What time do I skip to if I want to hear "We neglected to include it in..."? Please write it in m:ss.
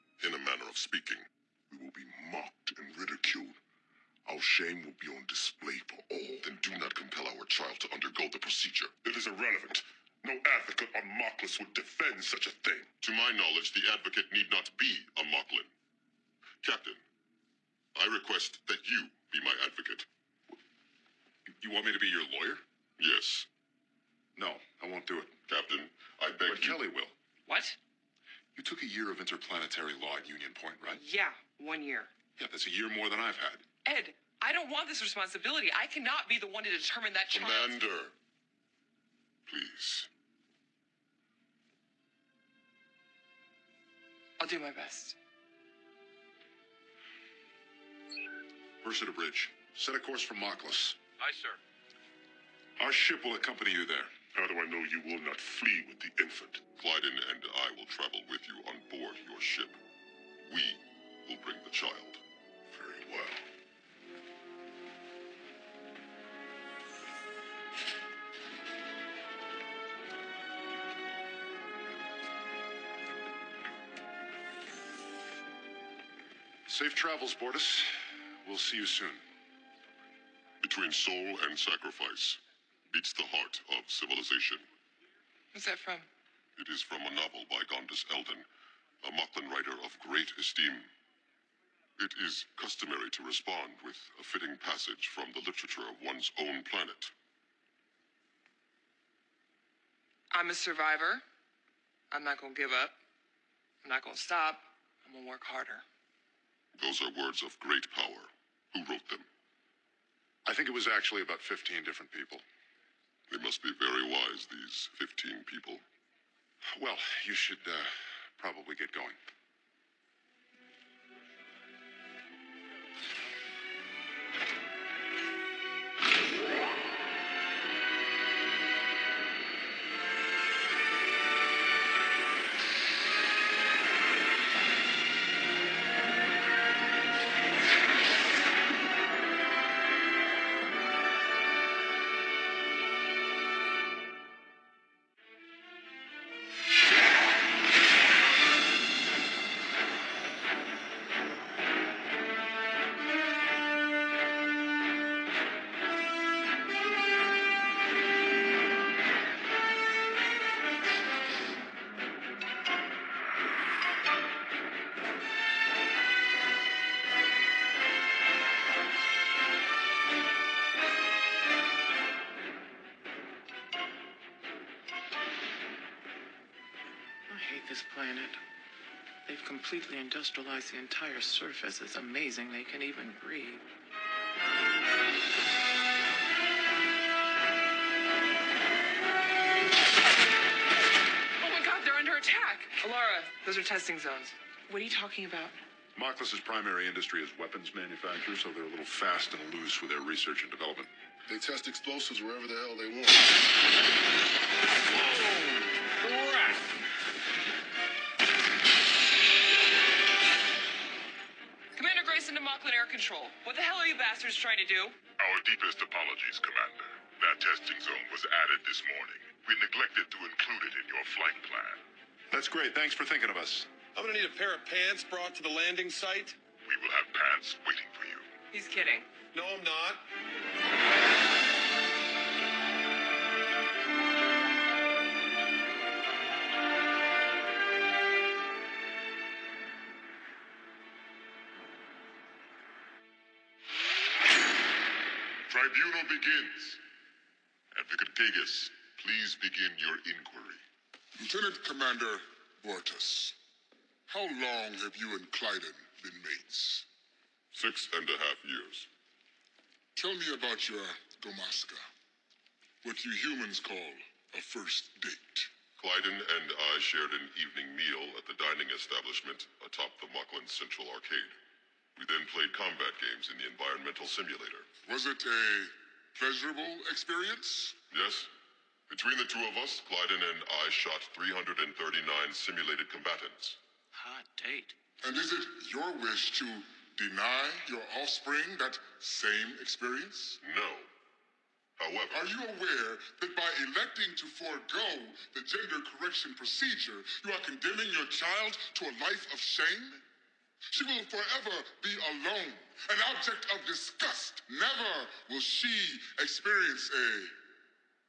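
3:39.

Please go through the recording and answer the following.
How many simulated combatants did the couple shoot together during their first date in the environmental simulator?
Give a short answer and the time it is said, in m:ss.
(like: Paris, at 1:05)
339, at 4:41.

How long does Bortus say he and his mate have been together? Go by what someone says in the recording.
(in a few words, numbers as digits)
6 and a half years.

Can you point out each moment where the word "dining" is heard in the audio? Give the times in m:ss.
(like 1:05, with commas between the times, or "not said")
4:28.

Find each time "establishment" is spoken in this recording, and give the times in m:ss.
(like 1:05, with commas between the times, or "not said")
4:28.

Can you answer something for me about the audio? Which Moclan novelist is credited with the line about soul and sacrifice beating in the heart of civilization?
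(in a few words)
Gondis Eldon.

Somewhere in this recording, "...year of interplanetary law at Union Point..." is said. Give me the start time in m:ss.
0:28.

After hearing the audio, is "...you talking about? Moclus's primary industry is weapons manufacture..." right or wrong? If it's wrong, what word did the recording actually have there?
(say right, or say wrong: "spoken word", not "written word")
right.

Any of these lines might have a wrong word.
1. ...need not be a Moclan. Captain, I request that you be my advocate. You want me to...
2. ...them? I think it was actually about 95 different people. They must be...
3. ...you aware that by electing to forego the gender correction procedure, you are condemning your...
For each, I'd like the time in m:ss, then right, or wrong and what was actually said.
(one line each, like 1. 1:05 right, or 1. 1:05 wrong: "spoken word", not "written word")
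1. 0:14 right
2. 1:49 wrong: "15", not "95"
3. 4:52 right.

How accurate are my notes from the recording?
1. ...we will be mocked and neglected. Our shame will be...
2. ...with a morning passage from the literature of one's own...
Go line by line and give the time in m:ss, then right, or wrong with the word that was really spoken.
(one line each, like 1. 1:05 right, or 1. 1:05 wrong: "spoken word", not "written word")
1. 0:01 wrong: "ridiculed", not "neglected"
2. 1:33 wrong: "fitting", not "morning".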